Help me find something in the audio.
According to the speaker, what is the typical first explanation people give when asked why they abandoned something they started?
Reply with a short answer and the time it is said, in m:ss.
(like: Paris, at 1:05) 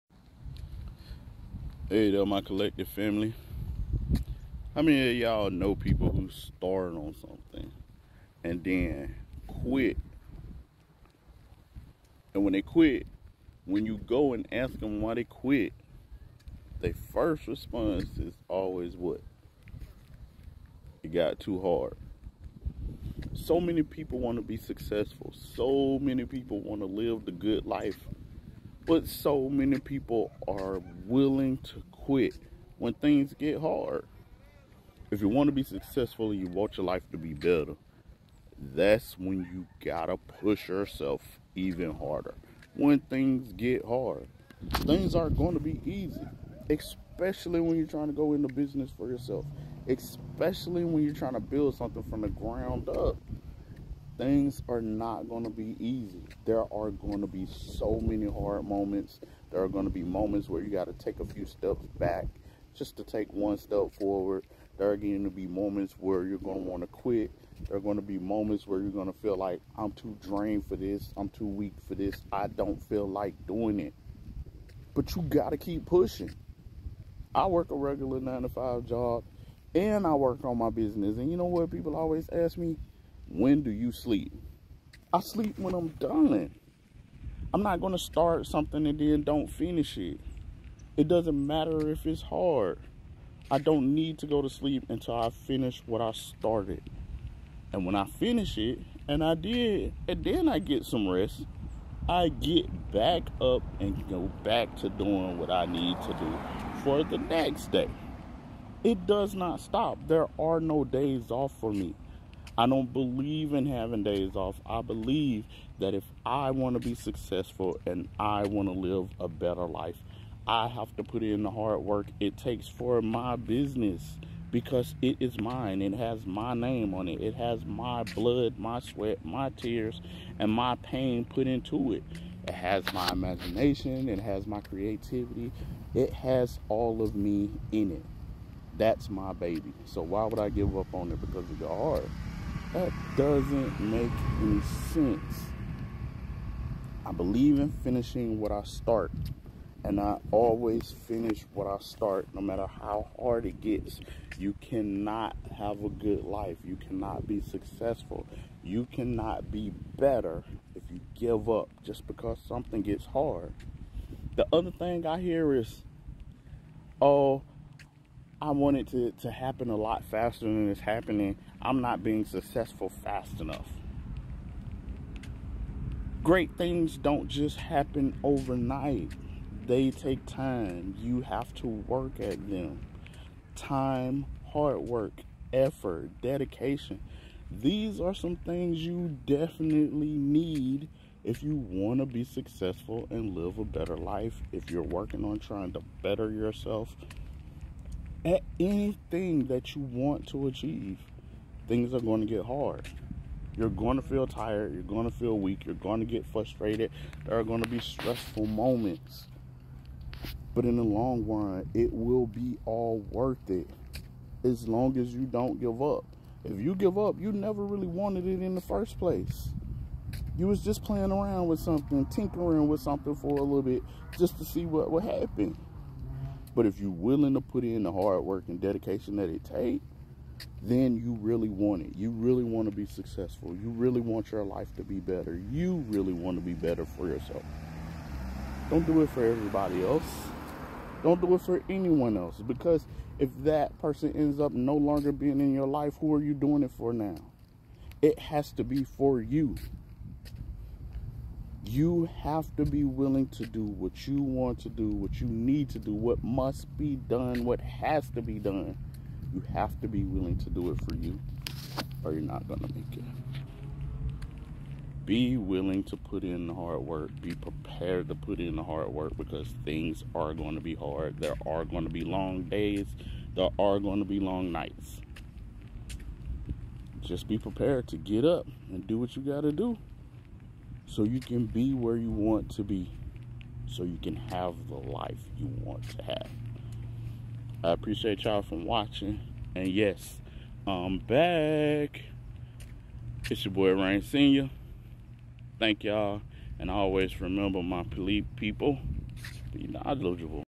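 It got too hard, at 0:21.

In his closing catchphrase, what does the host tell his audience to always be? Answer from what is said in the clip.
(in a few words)
Knowledgeable.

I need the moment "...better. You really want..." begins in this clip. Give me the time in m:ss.
3:54.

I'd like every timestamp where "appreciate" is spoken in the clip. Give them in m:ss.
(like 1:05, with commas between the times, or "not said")
4:47.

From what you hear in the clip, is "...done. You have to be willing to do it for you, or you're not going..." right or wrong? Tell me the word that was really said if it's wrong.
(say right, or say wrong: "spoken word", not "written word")
right.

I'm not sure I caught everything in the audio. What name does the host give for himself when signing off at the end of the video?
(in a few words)
Reign Senior.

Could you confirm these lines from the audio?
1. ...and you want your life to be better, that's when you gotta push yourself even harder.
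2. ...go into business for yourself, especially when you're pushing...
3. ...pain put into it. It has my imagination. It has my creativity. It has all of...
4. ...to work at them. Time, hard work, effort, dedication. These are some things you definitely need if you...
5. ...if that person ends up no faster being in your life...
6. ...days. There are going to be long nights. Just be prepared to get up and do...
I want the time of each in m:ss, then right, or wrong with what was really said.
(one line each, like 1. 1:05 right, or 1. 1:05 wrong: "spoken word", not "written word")
1. 0:36 right
2. 0:48 wrong: "trying", not "pushing"
3. 2:10 right
4. 3:01 right
5. 4:03 wrong: "longer", not "faster"
6. 4:32 right.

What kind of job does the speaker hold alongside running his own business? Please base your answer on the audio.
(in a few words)
nine to five job.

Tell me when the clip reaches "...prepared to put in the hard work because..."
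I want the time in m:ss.
4:27.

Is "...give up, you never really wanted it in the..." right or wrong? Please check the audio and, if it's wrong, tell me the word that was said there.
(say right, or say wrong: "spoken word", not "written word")
right.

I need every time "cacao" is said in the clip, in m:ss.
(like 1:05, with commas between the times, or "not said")
not said.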